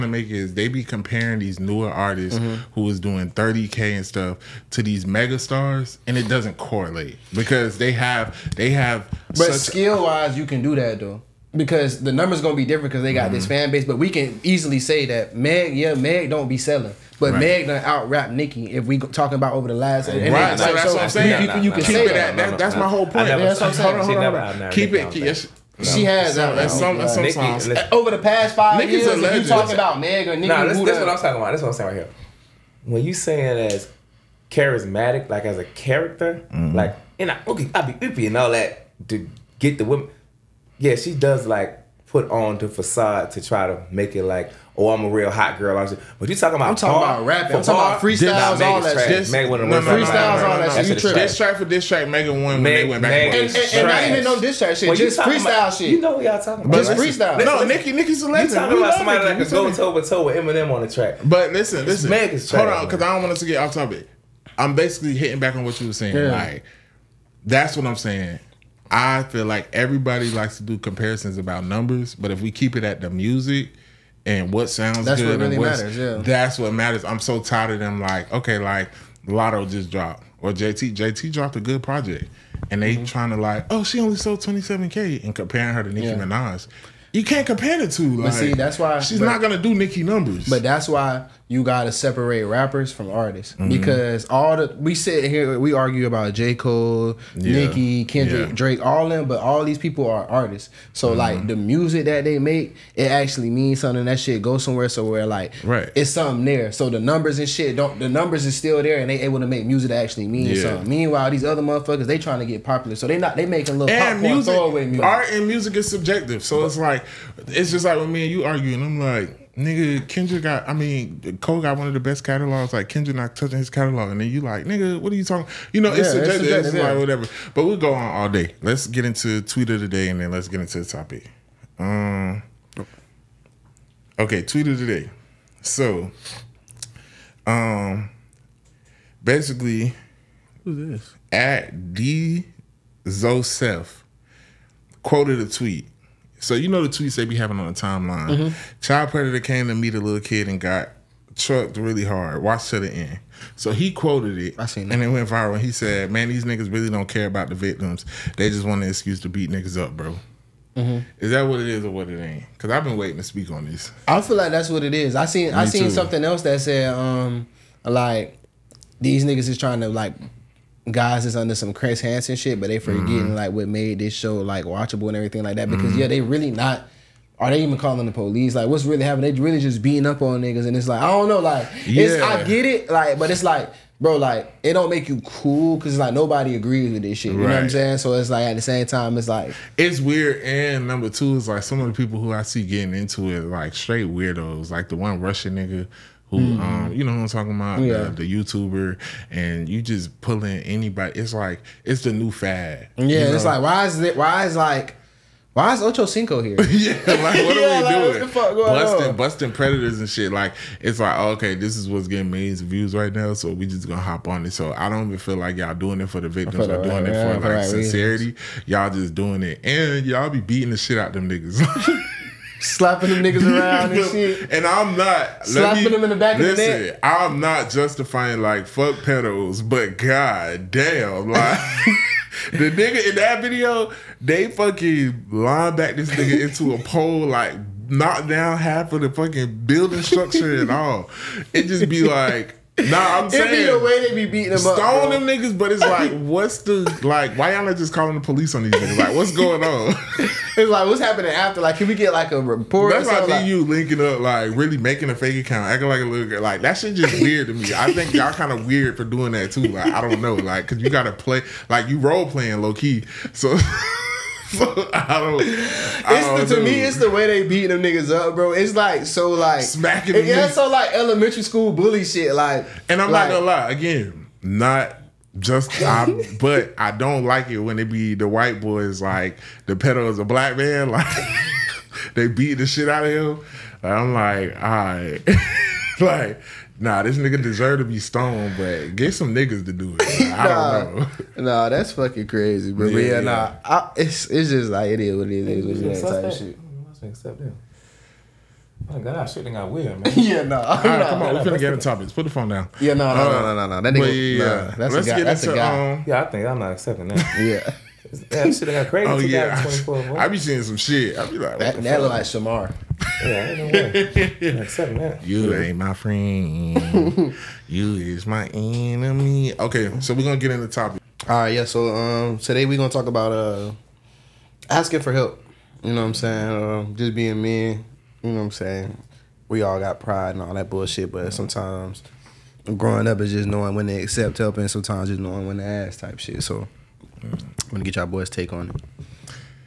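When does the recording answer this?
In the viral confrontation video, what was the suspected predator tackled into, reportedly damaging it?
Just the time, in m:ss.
3:56.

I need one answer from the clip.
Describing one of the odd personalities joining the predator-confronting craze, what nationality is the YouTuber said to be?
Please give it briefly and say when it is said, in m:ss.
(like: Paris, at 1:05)
Russian, at 3:15.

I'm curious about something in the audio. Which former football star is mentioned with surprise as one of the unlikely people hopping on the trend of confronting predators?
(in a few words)
Ocho Cinco.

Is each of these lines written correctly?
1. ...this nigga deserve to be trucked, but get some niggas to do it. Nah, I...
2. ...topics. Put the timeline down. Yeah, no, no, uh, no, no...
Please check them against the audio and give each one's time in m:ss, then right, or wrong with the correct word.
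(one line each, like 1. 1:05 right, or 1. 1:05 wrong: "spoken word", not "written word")
1. 4:47 wrong: "stoned", not "trucked"
2. 5:01 wrong: "phone", not "timeline".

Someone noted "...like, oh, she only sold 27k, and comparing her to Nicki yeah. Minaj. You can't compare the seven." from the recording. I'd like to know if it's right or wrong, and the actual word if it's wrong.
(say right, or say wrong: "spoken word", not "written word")
wrong: "two", not "seven".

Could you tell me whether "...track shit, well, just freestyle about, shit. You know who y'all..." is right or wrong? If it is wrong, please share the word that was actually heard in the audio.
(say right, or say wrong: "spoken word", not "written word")
right.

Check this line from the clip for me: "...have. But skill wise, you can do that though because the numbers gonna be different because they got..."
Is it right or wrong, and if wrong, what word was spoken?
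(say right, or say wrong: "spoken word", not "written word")
right.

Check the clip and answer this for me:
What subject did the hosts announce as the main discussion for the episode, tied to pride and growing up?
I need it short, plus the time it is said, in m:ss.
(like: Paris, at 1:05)
Asking for help, at 5:24.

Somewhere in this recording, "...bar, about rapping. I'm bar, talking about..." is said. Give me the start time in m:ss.
0:47.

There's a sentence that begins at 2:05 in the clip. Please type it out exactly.
You know, yeah, it's a It's, it's like, whatever.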